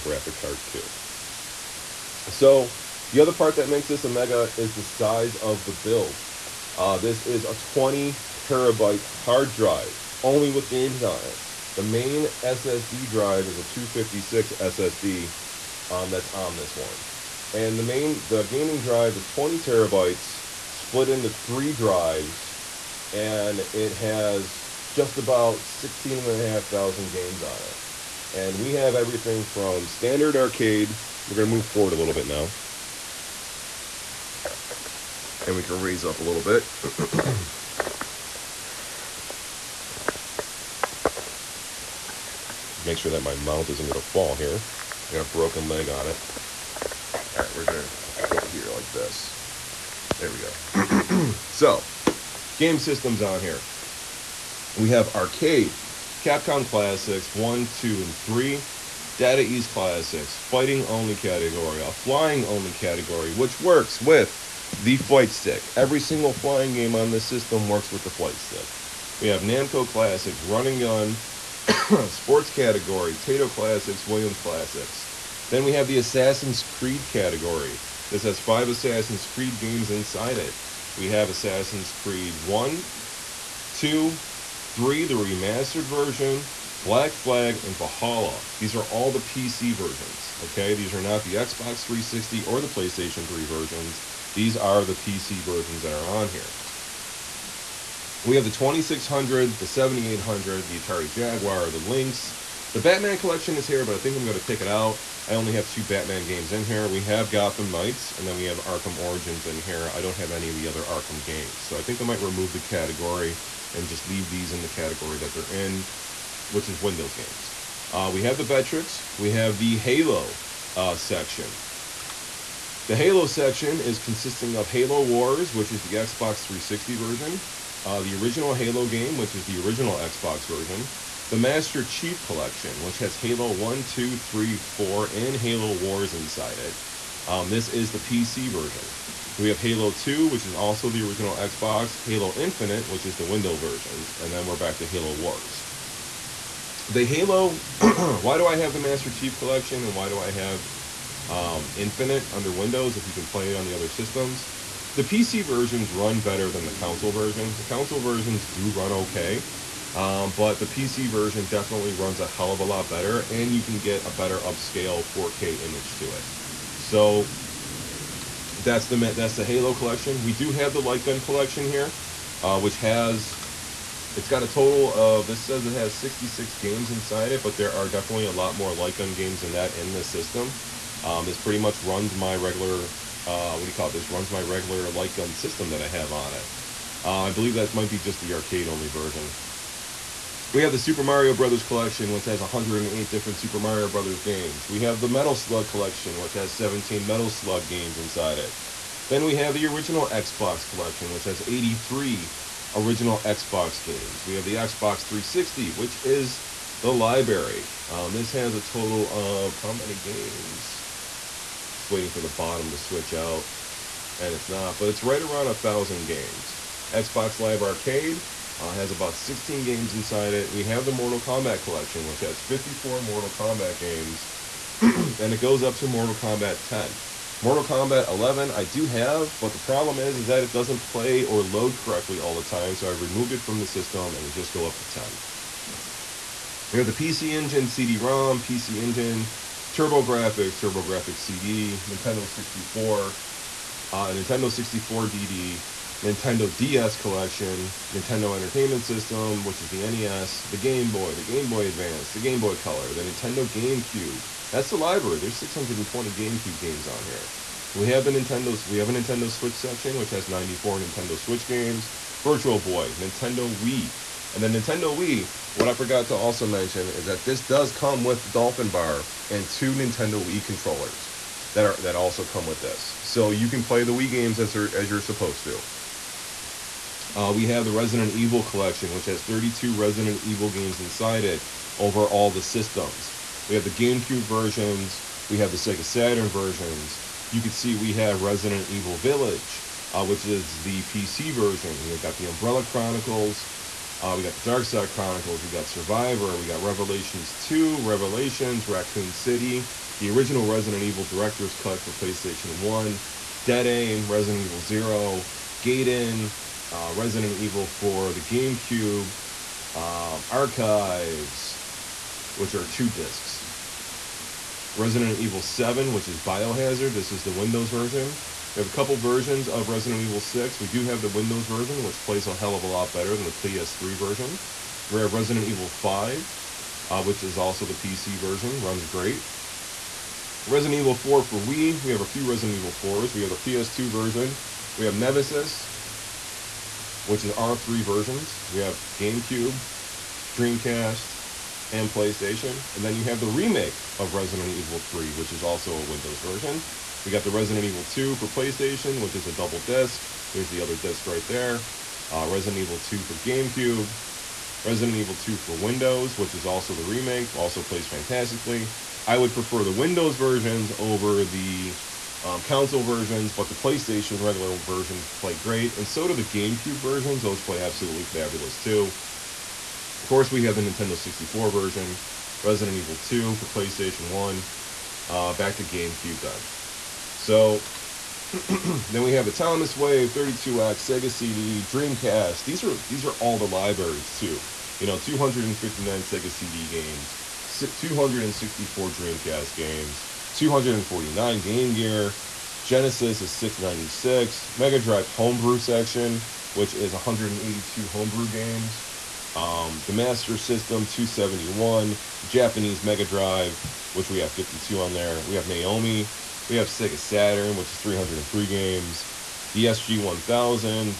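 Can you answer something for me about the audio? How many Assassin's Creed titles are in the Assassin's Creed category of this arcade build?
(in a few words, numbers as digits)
5.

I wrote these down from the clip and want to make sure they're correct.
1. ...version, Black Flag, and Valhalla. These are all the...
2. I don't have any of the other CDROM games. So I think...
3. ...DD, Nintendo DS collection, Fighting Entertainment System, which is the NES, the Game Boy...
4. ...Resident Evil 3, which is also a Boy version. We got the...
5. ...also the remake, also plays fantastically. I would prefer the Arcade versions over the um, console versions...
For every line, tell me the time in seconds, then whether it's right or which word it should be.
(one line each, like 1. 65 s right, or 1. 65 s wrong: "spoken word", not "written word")
1. 85 s right
2. 109 s wrong: "Arkham", not "CDROM"
3. 245 s wrong: "Nintendo", not "Fighting"
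4. 344 s wrong: "Windows", not "Boy"
5. 356 s wrong: "Windows", not "Arcade".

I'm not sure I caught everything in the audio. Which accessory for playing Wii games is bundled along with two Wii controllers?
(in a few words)
Dolphin Bar.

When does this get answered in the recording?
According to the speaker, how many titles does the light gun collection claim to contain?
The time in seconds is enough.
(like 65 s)
175 s.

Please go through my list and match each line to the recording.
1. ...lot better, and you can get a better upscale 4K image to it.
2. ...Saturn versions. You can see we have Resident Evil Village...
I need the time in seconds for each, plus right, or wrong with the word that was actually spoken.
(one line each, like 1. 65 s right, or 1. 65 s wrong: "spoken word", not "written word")
1. 162 s right
2. 285 s right.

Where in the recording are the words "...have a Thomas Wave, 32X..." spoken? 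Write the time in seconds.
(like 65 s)
379 s.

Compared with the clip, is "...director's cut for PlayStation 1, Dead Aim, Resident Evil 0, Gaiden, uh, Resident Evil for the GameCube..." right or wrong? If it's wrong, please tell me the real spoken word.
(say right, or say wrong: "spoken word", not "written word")
right.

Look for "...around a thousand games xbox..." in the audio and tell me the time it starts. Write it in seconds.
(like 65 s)
215 s.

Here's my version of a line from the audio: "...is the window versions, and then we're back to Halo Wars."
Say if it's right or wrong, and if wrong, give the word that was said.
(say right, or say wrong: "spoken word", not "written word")
right.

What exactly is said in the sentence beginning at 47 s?
All right, we're going to go here like this.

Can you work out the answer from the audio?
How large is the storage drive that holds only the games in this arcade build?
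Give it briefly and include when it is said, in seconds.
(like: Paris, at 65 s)
20 terabytes, at 7 s.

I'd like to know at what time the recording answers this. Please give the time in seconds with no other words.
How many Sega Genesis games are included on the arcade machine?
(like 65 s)
393 s.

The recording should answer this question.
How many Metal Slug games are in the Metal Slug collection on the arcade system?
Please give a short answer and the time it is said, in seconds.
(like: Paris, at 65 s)
17, at 196 s.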